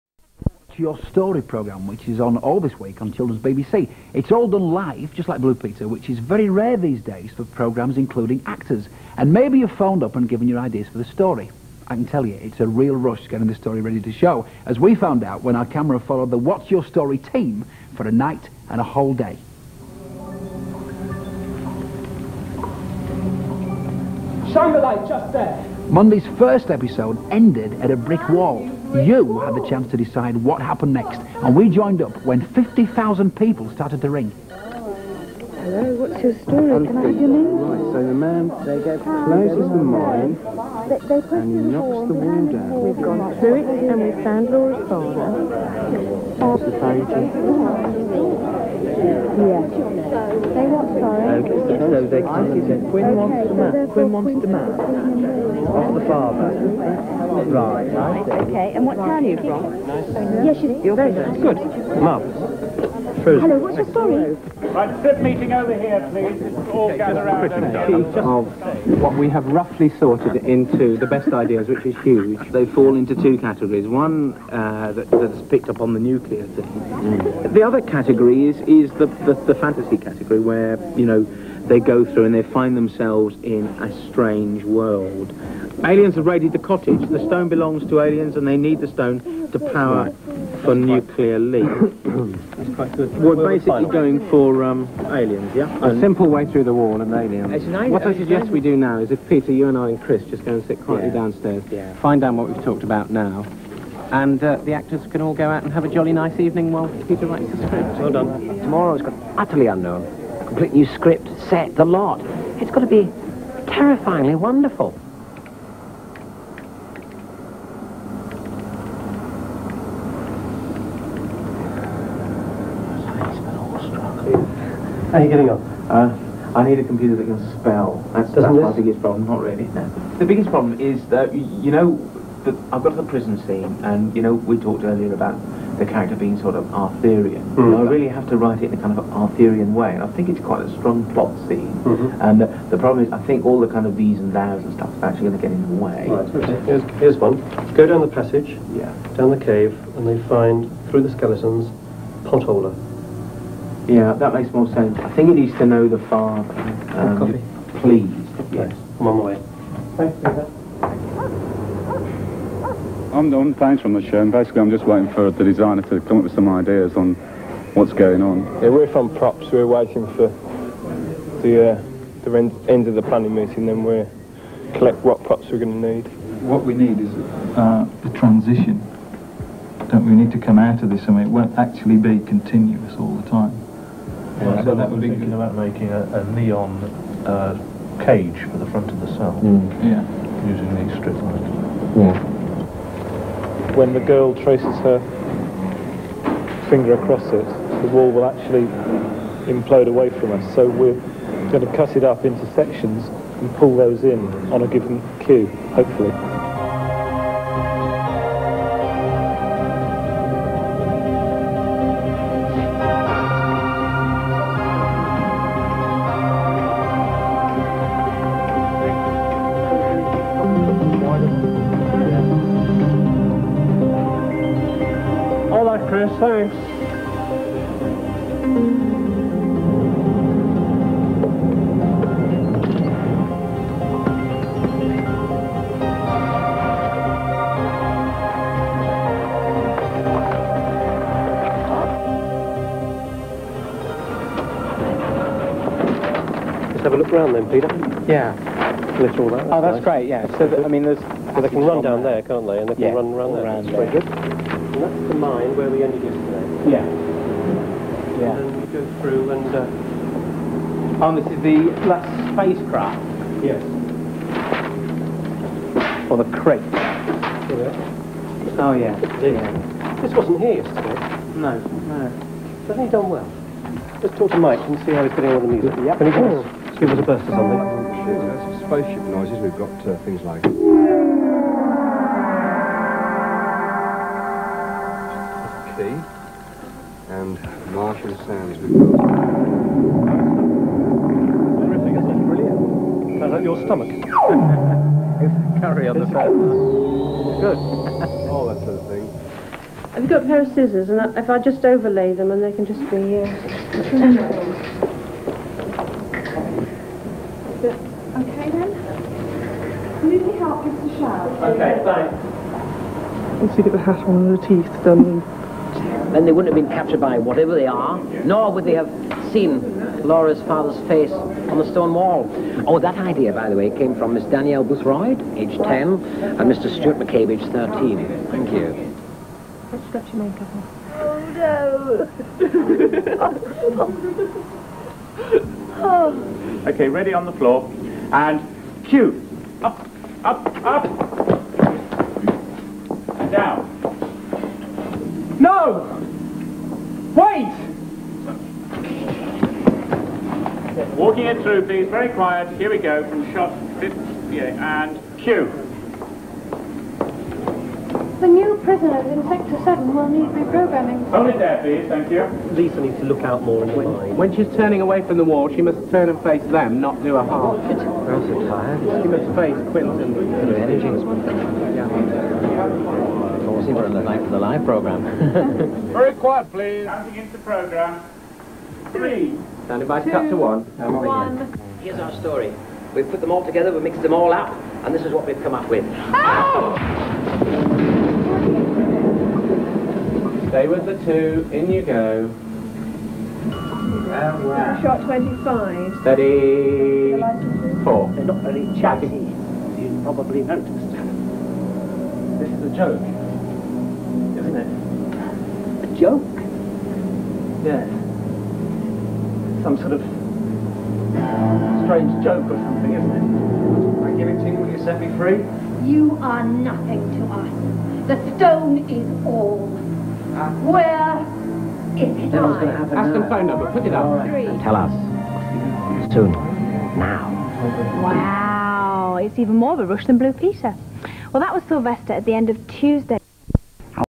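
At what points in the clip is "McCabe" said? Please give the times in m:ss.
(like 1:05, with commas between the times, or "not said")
5:26.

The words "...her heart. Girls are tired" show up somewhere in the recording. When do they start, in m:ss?
6:07.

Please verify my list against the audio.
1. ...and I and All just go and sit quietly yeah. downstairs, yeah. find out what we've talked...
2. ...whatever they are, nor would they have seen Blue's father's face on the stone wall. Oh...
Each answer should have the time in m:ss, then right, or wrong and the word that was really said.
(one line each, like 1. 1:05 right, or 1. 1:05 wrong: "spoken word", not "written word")
1. 1:39 wrong: "Chris", not "All"
2. 5:17 wrong: "Laura", not "Blue".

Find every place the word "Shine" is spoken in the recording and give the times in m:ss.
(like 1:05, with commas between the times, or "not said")
0:24.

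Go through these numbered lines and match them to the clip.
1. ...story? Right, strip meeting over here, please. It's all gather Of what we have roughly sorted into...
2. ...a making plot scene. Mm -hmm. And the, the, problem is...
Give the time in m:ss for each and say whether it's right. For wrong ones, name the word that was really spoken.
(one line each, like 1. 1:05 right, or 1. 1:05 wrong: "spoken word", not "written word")
1. 1:03 right
2. 2:20 wrong: "strong", not "making".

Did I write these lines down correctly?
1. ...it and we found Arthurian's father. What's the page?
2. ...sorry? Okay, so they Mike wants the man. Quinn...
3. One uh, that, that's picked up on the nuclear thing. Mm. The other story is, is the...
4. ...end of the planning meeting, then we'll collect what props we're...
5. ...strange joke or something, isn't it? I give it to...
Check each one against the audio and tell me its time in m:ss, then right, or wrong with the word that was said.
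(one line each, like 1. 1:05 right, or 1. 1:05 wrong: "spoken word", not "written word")
1. 0:43 wrong: "Laura", not "Arthurian"
2. 0:50 wrong: "Quinn", not "Mike"
3. 1:13 wrong: "category", not "story"
4. 2:52 right
5. 6:51 right.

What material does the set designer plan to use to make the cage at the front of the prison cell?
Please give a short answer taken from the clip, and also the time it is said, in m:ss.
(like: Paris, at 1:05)
neon, at 3:06.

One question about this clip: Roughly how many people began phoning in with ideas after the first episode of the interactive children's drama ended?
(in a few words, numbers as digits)
50,000.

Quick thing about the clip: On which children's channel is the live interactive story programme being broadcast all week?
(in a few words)
Children's BBC.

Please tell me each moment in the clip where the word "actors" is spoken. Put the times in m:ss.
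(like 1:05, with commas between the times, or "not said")
0:08, 1:44.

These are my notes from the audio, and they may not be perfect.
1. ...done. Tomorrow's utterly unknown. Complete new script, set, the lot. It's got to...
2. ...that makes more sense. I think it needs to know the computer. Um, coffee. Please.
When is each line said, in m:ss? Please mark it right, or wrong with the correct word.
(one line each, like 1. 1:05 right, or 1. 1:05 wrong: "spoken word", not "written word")
1. 1:48 right
2. 2:34 wrong: "father", not "computer".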